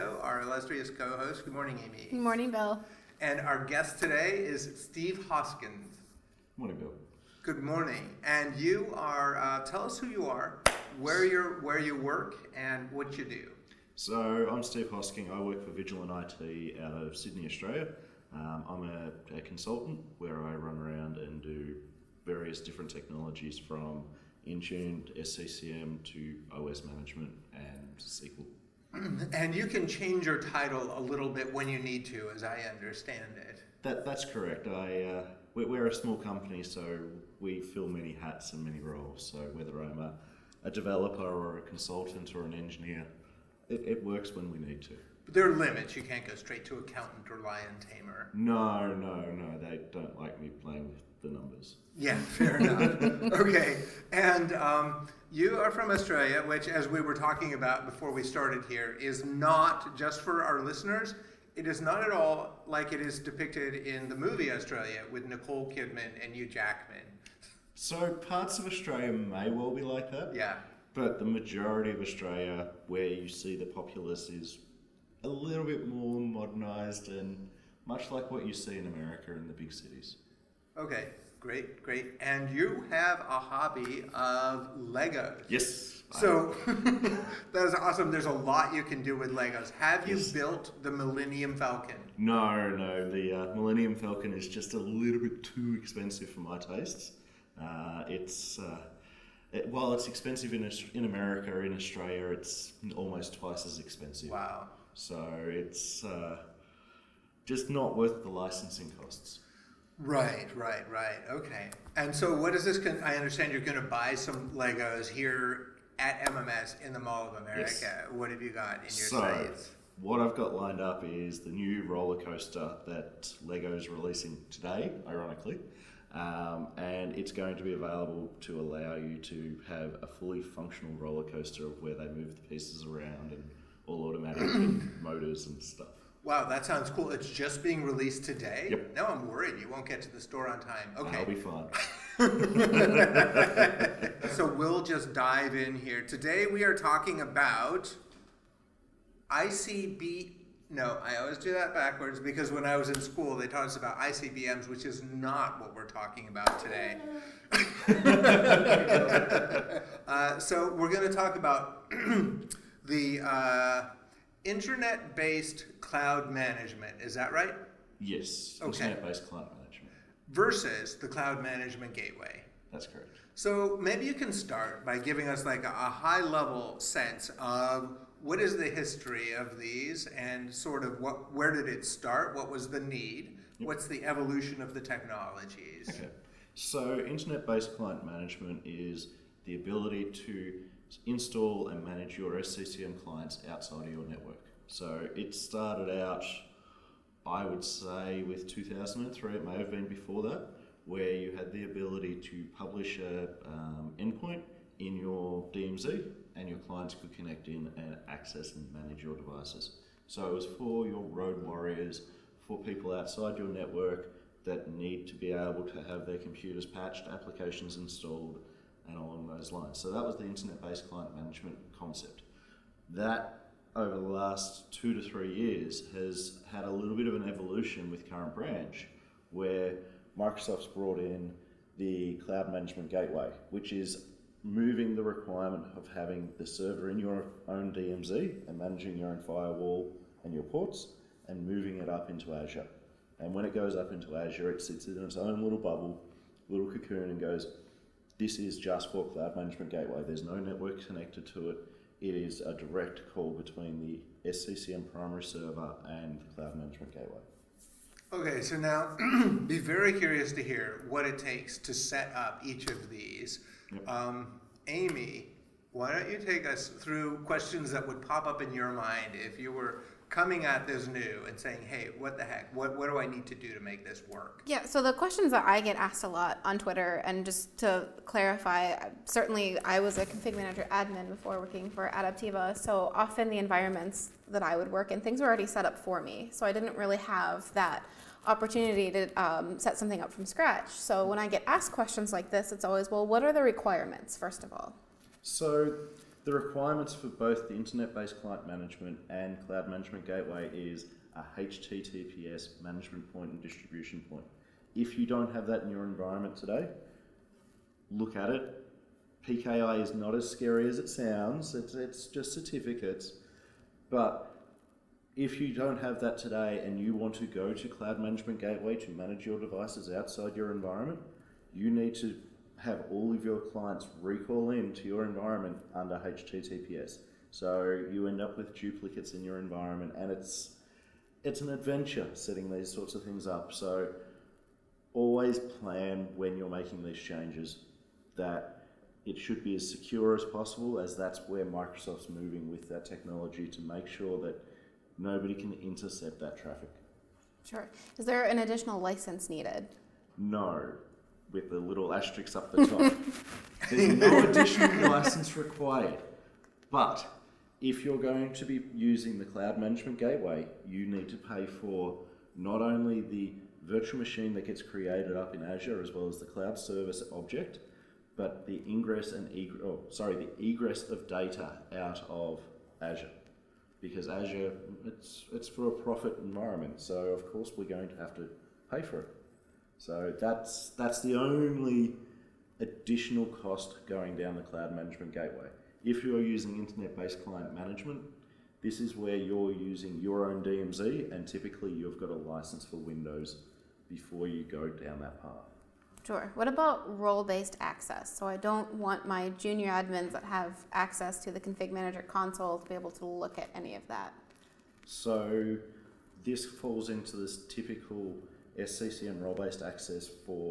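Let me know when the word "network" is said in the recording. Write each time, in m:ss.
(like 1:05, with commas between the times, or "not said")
3:14, 3:33, 4:10.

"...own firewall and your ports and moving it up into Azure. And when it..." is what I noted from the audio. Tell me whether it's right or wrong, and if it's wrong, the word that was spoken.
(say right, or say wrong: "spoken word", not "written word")
right.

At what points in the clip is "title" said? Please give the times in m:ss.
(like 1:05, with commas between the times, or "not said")
0:30.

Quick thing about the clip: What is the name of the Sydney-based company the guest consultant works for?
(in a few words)
Vigilant IT.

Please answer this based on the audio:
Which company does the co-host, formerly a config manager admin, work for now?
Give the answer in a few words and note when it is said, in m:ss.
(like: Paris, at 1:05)
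Adaptiva, at 4:41.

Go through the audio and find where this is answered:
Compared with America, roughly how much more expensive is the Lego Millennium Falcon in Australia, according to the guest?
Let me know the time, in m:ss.
1:42.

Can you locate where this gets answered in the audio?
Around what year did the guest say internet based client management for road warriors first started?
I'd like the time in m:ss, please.
3:18.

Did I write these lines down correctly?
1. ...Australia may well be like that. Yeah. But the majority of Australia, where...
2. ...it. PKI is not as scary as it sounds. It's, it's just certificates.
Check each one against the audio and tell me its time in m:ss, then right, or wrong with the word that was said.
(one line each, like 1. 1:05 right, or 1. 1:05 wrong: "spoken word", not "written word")
1. 1:08 right
2. 5:08 right.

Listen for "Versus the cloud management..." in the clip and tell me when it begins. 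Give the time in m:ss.
2:50.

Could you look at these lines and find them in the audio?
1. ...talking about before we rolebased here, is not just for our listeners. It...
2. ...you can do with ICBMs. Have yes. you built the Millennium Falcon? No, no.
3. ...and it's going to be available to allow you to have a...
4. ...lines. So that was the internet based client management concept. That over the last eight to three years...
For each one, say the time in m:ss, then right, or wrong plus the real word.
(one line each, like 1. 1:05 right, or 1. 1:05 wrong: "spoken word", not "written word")
1. 0:57 wrong: "started", not "rolebased"
2. 1:28 wrong: "Legos", not "ICBMs"
3. 2:06 right
4. 3:39 wrong: "two", not "eight".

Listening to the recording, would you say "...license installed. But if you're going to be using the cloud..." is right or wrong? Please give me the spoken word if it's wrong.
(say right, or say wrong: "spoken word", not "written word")
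wrong: "required", not "installed".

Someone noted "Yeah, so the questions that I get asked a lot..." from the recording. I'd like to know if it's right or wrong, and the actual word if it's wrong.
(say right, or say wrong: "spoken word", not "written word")
right.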